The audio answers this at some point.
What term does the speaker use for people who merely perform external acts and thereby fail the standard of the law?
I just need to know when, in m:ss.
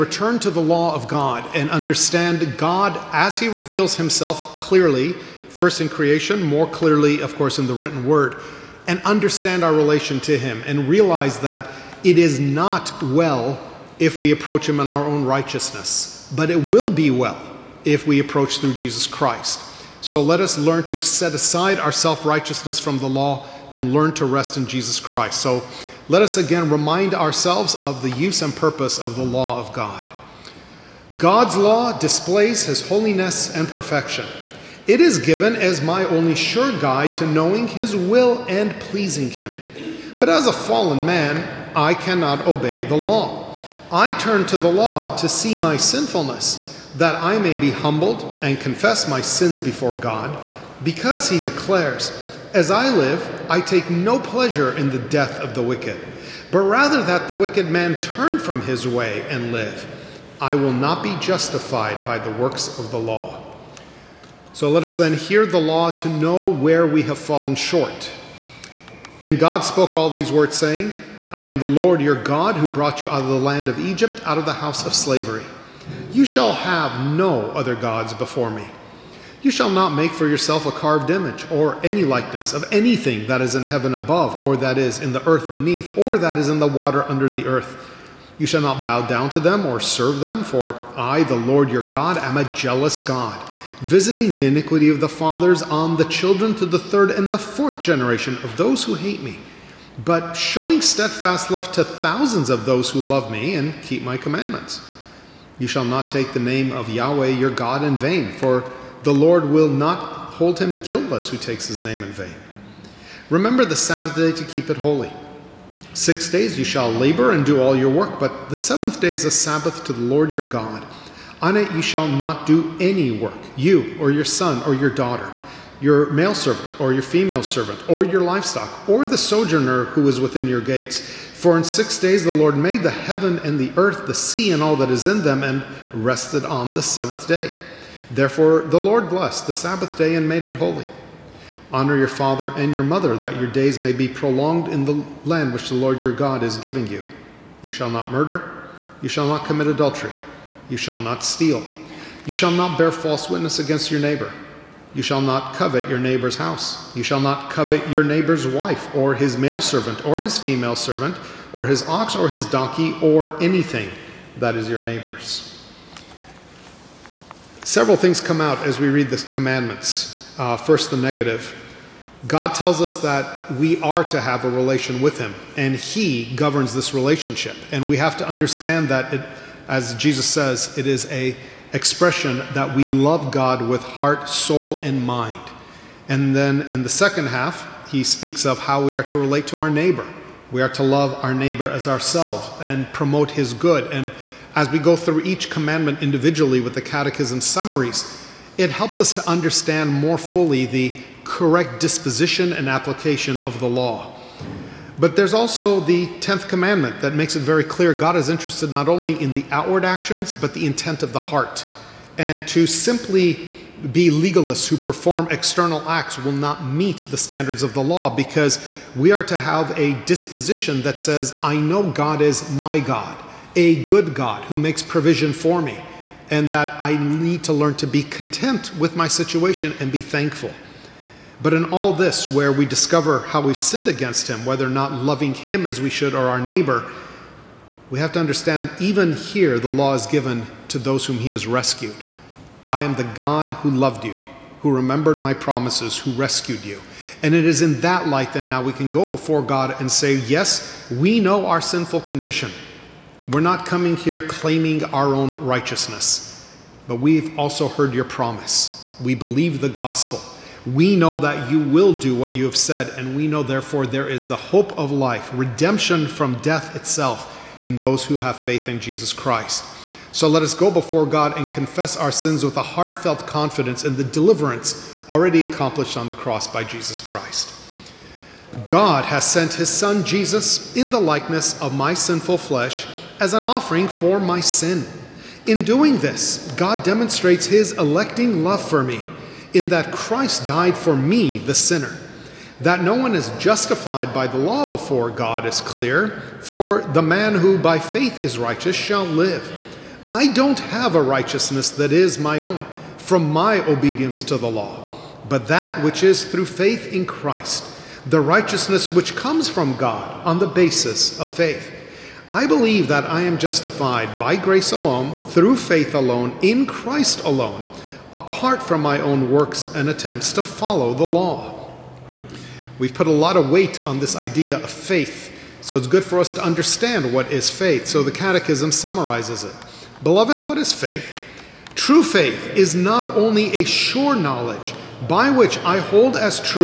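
3:34.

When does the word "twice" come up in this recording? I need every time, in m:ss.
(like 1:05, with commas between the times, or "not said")
not said.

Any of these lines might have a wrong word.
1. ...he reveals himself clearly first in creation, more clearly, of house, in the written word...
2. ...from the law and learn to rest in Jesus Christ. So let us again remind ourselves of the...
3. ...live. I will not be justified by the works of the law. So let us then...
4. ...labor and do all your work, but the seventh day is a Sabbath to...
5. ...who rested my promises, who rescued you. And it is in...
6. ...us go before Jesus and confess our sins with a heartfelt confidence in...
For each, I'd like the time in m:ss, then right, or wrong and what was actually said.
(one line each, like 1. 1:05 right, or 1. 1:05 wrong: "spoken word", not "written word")
1. 0:03 wrong: "course", not "house"
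2. 0:22 right
3. 0:59 right
4. 1:56 right
5. 4:04 wrong: "remembered", not "rested"
6. 4:30 wrong: "God", not "Jesus".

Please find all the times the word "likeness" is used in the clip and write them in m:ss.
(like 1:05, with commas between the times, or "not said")
1:22, 4:41.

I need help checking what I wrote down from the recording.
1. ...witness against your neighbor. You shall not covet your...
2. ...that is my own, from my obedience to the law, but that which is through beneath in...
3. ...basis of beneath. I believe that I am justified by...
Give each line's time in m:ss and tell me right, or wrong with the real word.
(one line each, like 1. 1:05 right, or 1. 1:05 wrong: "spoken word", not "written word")
1. 2:33 right
2. 5:01 wrong: "faith", not "beneath"
3. 5:10 wrong: "faith", not "beneath".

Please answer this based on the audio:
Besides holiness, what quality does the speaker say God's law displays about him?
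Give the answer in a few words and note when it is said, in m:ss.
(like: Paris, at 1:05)
perfection, at 0:33.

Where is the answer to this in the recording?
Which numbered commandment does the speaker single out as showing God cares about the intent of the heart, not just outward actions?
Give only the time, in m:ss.
3:26.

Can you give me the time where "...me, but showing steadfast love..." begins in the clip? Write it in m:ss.
1:39.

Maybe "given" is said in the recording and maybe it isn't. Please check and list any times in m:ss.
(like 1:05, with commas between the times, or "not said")
0:35, 4:00.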